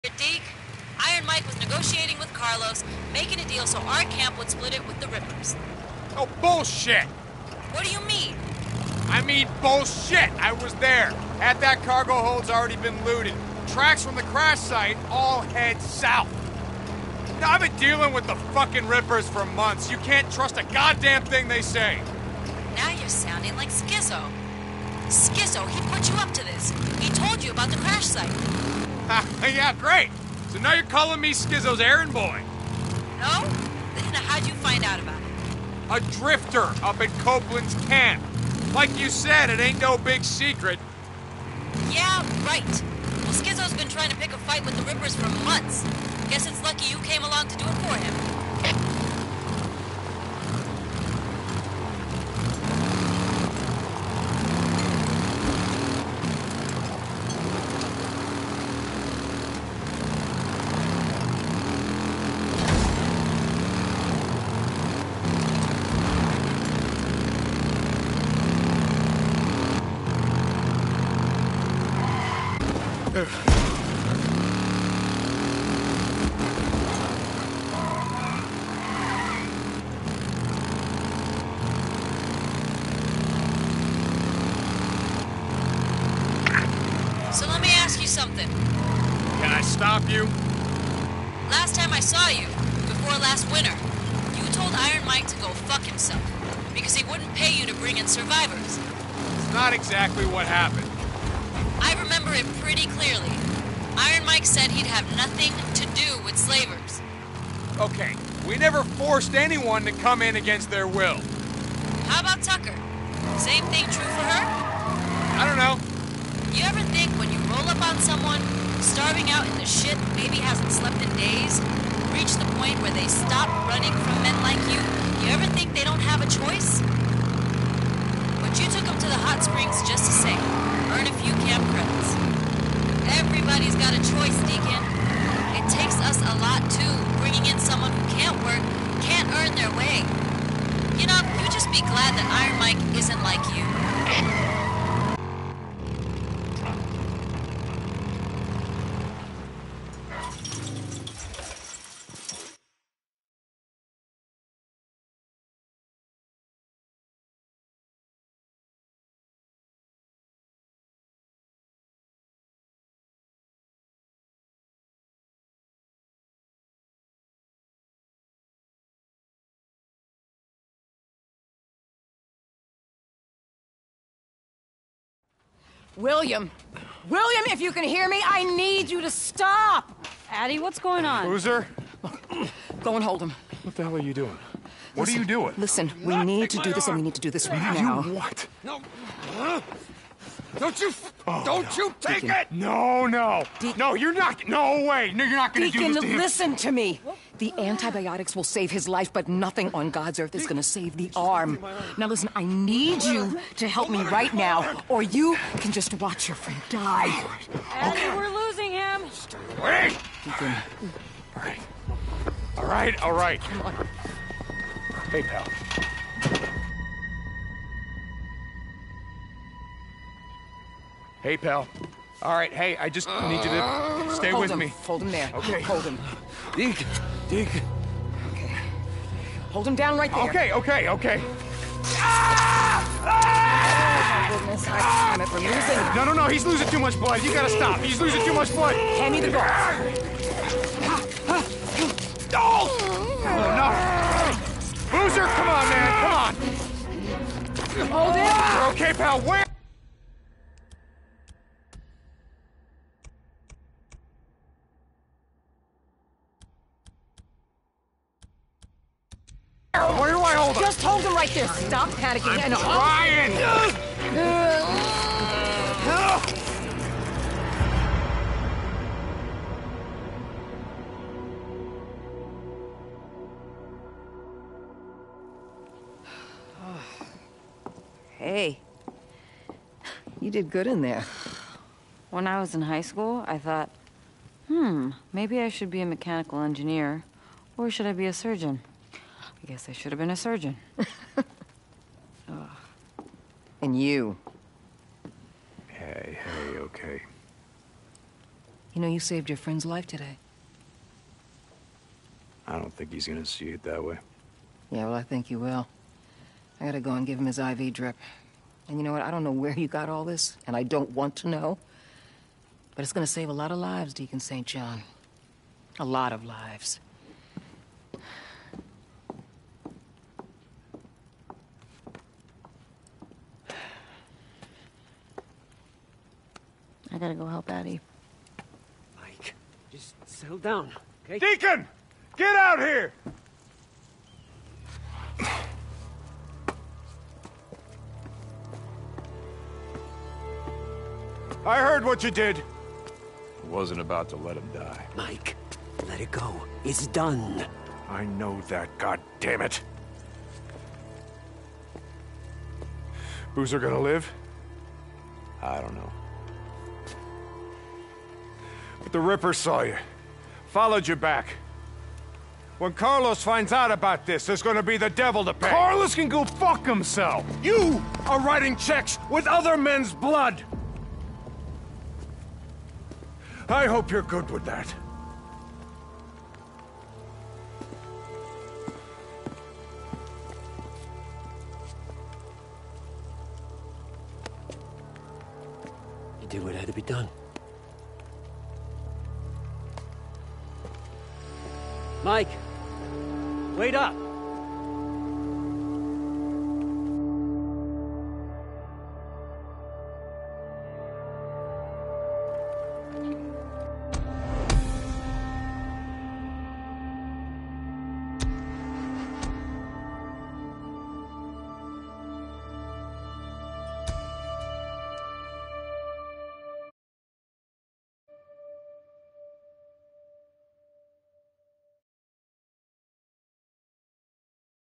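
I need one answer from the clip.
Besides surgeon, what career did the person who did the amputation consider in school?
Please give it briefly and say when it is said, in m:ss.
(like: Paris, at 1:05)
Mechanical engineer, at 4:45.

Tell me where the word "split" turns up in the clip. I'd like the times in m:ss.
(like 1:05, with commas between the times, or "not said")
0:04.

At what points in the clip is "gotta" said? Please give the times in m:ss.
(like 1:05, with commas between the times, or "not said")
3:57, 5:06, 5:27.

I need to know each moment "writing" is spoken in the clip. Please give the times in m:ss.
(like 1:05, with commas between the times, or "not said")
6:08.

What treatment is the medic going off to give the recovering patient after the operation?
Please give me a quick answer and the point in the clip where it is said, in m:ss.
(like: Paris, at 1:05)
IV drip, at 5:07.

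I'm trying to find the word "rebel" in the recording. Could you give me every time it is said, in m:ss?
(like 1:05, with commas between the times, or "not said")
not said.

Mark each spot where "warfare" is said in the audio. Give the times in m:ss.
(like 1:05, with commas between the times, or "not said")
not said.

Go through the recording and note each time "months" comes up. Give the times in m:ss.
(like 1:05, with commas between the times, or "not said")
0:19, 0:45.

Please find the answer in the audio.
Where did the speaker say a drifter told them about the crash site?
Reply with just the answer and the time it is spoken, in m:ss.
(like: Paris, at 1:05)
Copeland's camp, at 0:37.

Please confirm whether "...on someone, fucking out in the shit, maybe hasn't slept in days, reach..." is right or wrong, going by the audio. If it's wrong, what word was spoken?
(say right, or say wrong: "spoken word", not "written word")
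wrong: "starving", not "fucking".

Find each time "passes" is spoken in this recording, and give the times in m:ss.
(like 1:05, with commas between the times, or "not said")
not said.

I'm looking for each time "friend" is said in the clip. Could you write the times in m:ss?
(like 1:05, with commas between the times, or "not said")
3:26, 4:59.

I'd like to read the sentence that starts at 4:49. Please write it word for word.
I guess I should have been a surgeon.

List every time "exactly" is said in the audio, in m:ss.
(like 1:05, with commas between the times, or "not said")
1:39.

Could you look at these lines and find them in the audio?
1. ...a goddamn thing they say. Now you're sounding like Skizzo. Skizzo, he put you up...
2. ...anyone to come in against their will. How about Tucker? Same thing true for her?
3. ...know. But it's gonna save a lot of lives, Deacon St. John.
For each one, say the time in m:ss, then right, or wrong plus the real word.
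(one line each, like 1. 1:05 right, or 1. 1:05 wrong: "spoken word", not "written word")
1. 0:20 right
2. 1:49 right
3. 5:11 right.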